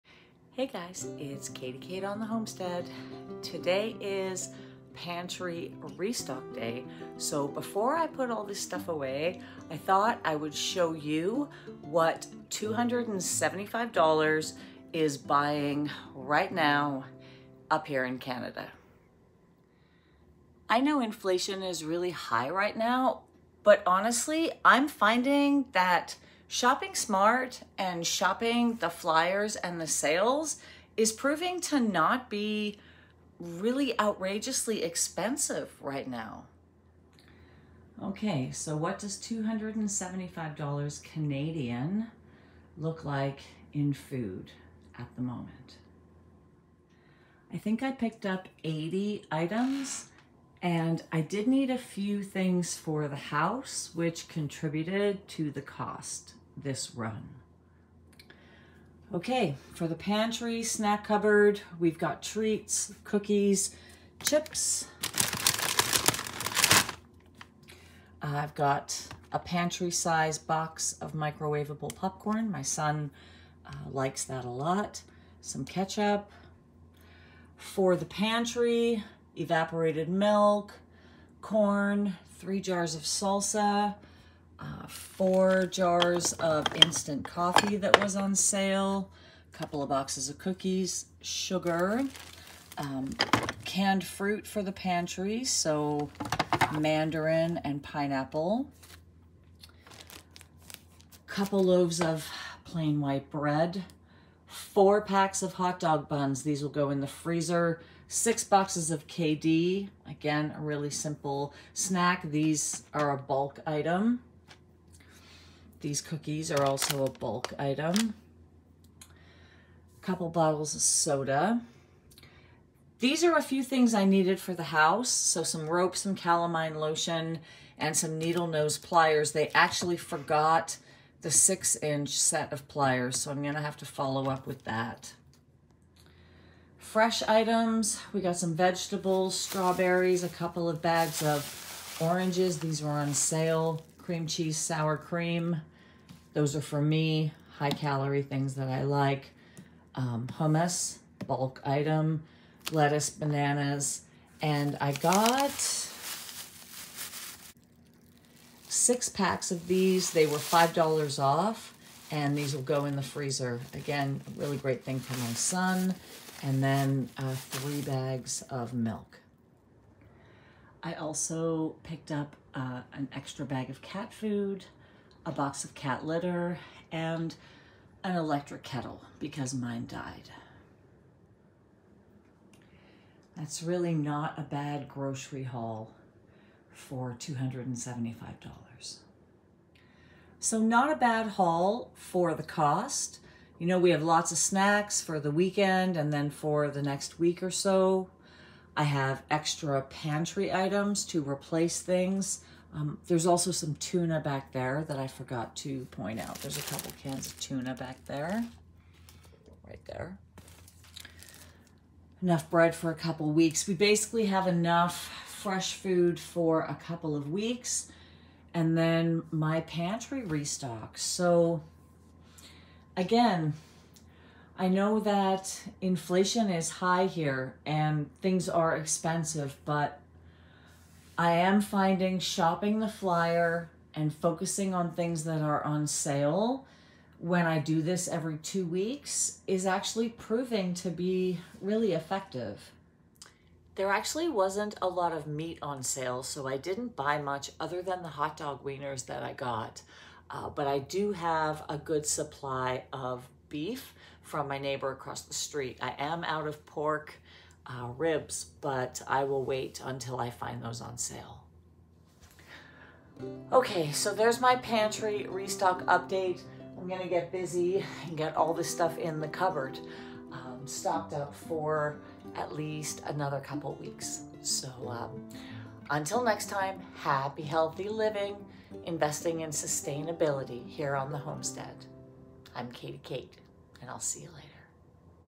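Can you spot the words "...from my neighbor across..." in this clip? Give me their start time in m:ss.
4:14.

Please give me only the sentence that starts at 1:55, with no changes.
These cookies are also a bulk item.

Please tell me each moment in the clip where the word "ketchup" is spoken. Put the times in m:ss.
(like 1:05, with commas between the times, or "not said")
1:15.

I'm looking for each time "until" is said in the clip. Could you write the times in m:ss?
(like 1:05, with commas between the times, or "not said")
4:19, 4:35.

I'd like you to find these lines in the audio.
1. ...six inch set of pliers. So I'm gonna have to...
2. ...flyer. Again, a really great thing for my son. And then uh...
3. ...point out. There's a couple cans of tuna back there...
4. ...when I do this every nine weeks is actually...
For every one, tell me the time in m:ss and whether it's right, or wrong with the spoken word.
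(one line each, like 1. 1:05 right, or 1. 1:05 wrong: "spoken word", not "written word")
1. 2:11 right
2. 2:43 wrong: "freezer", not "flyer"
3. 3:25 right
4. 3:57 wrong: "two", not "nine".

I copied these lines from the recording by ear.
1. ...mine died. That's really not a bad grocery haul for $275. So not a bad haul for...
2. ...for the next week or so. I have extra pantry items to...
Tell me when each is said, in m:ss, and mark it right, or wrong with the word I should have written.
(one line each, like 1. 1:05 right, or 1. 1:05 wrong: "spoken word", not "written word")
1. 2:59 right
2. 3:16 right.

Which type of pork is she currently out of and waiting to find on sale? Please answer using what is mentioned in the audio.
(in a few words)
ribs.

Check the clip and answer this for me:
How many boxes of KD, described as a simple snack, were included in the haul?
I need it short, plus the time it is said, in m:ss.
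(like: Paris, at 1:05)
6, at 1:48.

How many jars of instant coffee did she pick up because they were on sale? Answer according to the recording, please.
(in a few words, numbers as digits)
4.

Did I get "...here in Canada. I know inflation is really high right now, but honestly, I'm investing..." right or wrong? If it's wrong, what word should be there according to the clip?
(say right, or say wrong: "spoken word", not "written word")
wrong: "finding", not "investing".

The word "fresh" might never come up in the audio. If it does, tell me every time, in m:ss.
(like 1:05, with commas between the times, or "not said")
2:16, 3:35.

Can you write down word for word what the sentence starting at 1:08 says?
I've got a pantry size box of microwavable popcorn.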